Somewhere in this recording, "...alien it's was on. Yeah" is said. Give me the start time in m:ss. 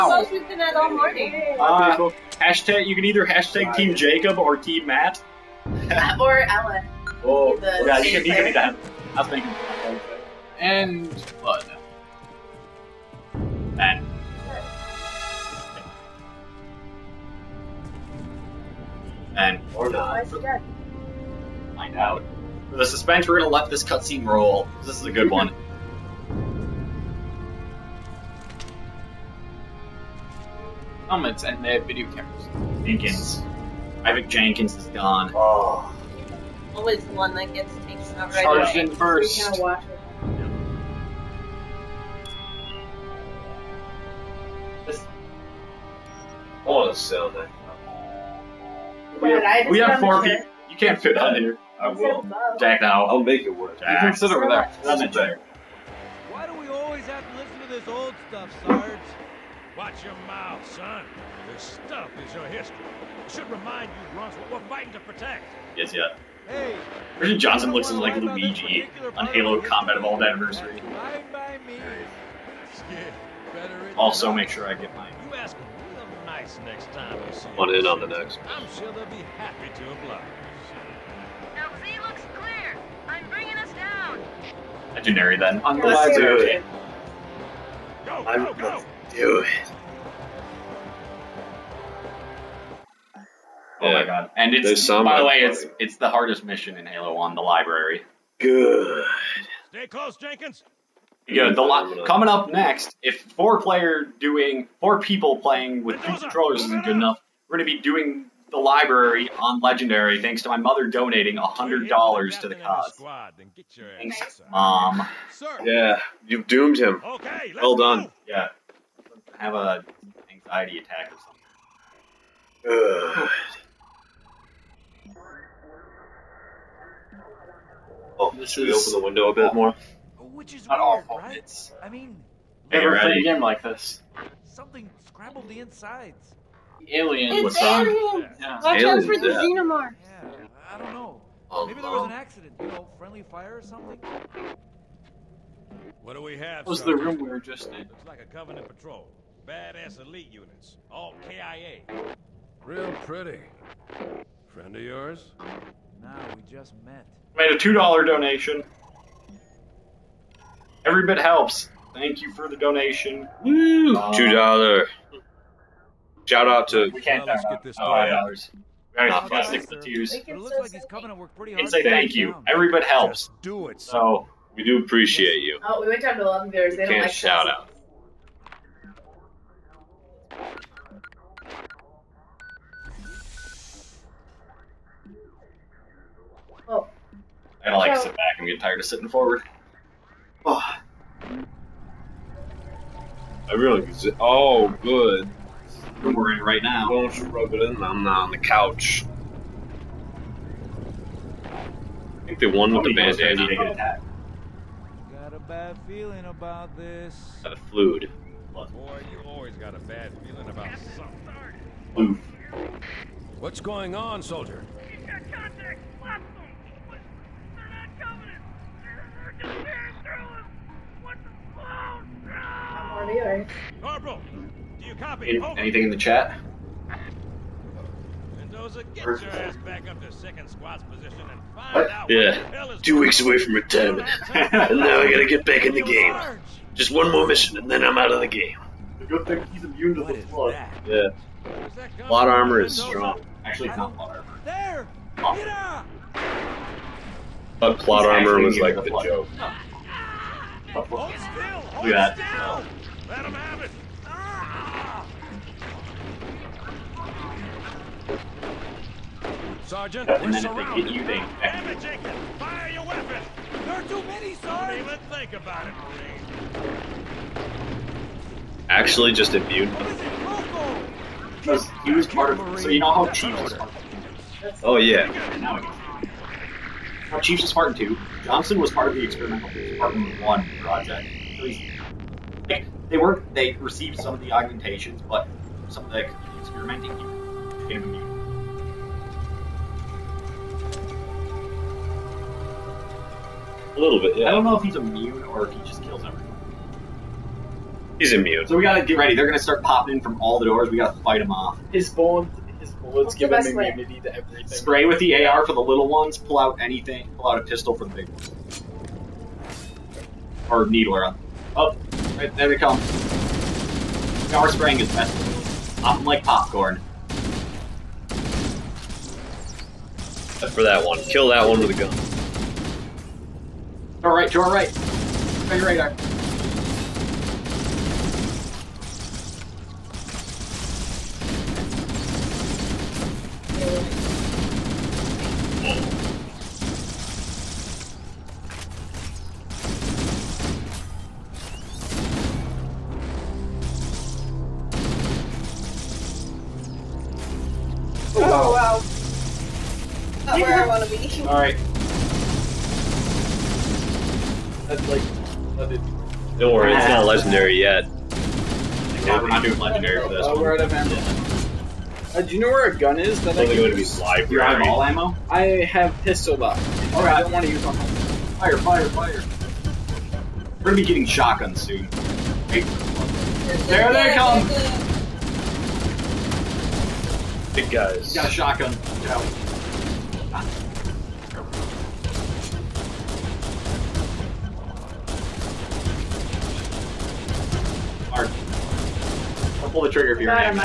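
2:16.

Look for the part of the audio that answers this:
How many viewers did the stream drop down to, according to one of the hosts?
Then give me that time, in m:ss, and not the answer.
2:56.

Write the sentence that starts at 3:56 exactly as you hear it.
Just one more mission and then I'm out of the game.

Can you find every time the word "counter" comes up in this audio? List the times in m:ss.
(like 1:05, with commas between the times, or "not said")
not said.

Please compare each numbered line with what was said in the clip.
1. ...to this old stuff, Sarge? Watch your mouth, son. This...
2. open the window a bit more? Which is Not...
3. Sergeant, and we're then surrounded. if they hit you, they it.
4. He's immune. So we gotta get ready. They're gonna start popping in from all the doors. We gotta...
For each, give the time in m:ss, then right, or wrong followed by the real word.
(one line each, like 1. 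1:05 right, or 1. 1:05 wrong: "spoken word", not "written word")
1. 0:57 right
2. 2:08 right
3. 4:19 right
4. 4:57 right.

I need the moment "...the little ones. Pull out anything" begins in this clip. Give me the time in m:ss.
5:05.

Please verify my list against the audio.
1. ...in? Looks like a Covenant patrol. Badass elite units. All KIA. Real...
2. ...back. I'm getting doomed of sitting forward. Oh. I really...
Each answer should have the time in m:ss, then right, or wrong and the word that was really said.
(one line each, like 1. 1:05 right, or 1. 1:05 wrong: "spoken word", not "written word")
1. 2:27 right
2. 3:08 wrong: "tired", not "doomed".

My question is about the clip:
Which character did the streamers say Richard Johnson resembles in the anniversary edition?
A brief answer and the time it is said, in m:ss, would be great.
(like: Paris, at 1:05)
Luigi, at 1:08.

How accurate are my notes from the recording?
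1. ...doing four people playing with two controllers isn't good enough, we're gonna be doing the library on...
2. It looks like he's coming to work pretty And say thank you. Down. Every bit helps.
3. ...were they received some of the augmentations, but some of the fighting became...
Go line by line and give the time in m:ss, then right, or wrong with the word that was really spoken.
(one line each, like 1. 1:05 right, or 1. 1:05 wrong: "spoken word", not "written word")
1. 1:44 right
2. 2:50 right
3. 4:42 wrong: "experimenting", not "fighting".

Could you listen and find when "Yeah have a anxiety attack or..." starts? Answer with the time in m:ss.
1:58.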